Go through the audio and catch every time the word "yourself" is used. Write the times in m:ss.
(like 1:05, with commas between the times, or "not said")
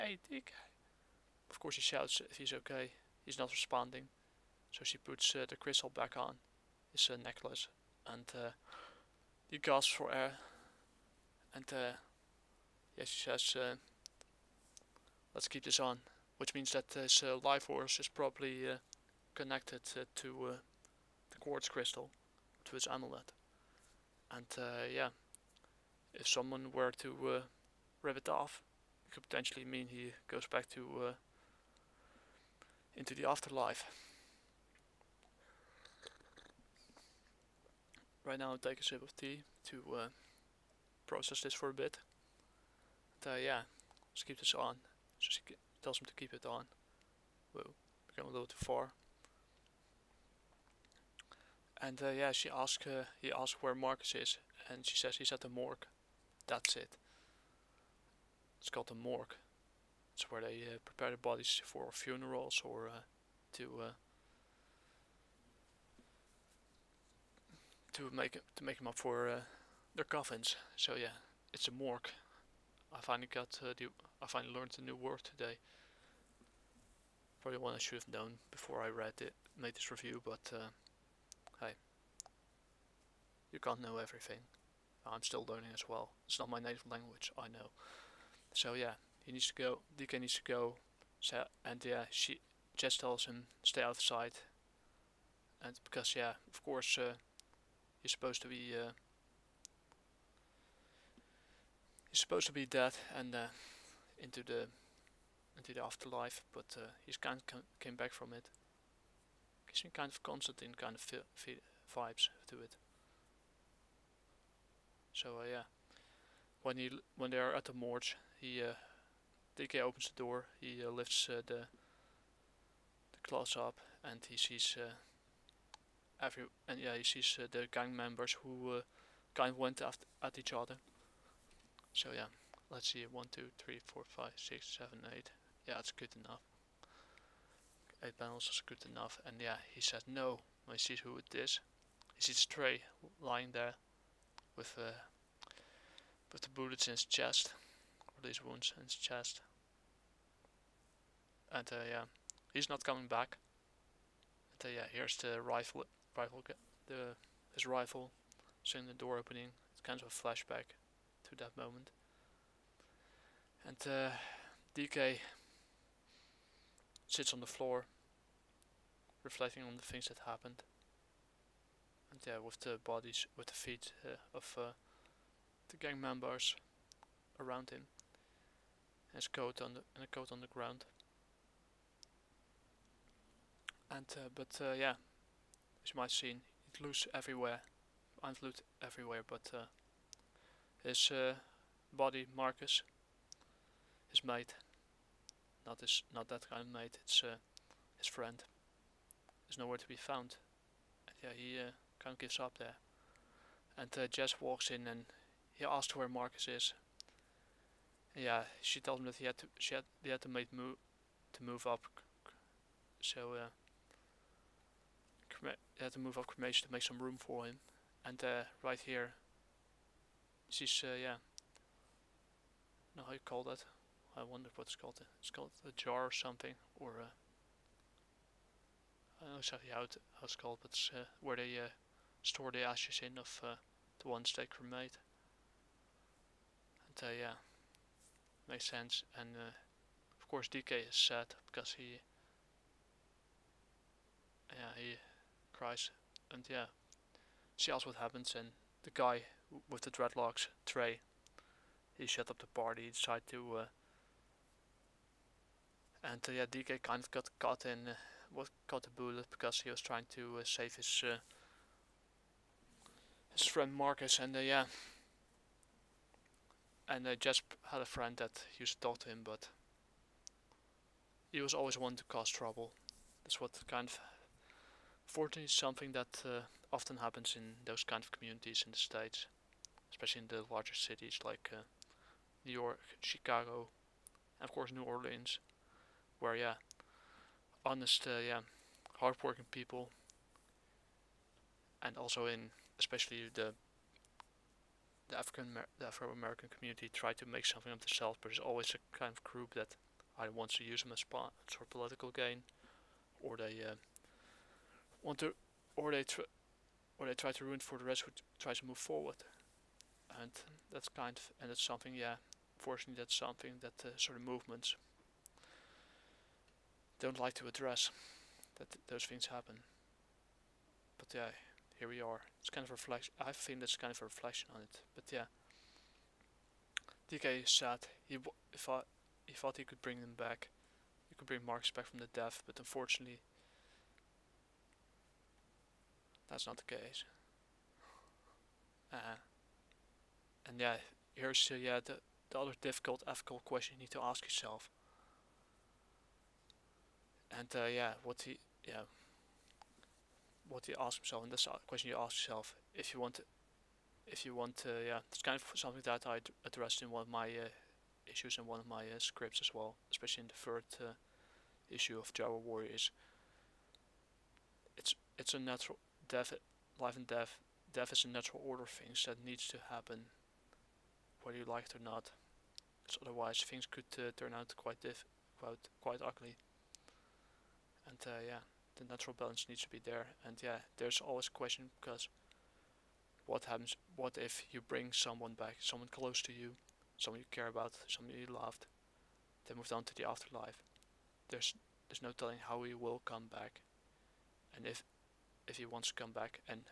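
5:44, 5:52.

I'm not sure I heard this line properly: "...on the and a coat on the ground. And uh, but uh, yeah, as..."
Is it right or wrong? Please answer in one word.
right.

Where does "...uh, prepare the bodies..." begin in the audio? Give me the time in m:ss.
1:00.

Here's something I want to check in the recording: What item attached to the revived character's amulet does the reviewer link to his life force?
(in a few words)
quartz crystal.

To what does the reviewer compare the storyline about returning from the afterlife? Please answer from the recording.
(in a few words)
Constantine.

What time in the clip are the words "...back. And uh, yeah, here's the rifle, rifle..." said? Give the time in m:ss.
2:33.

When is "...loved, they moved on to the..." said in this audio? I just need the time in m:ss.
6:28.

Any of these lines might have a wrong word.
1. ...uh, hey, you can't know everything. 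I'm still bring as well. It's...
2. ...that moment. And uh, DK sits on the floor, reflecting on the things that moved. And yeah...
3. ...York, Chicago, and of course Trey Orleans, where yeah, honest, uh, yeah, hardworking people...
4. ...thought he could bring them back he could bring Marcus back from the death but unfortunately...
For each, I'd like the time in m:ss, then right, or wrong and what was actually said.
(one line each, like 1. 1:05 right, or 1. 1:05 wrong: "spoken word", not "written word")
1. 1:20 wrong: "learning", not "bring"
2. 2:41 wrong: "happened", not "moved"
3. 4:42 wrong: "New", not "Trey"
4. 5:29 right.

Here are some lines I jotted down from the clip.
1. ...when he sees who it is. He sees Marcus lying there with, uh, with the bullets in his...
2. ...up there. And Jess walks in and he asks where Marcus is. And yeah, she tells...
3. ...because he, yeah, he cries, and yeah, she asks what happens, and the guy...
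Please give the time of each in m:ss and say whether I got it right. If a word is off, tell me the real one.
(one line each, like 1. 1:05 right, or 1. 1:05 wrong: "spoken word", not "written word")
1. 2:20 wrong: "Trey", not "Marcus"
2. 3:22 right
3. 4:01 right.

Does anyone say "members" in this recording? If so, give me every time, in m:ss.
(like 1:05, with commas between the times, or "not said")
2:07, 2:56.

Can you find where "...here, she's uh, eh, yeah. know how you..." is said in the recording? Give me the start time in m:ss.
3:38.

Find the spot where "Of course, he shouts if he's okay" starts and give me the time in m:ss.
0:01.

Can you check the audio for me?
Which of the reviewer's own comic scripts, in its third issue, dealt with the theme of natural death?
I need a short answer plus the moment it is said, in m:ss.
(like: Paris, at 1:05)
Java Warriors, at 6:02.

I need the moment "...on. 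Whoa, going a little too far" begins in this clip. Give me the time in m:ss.
0:46.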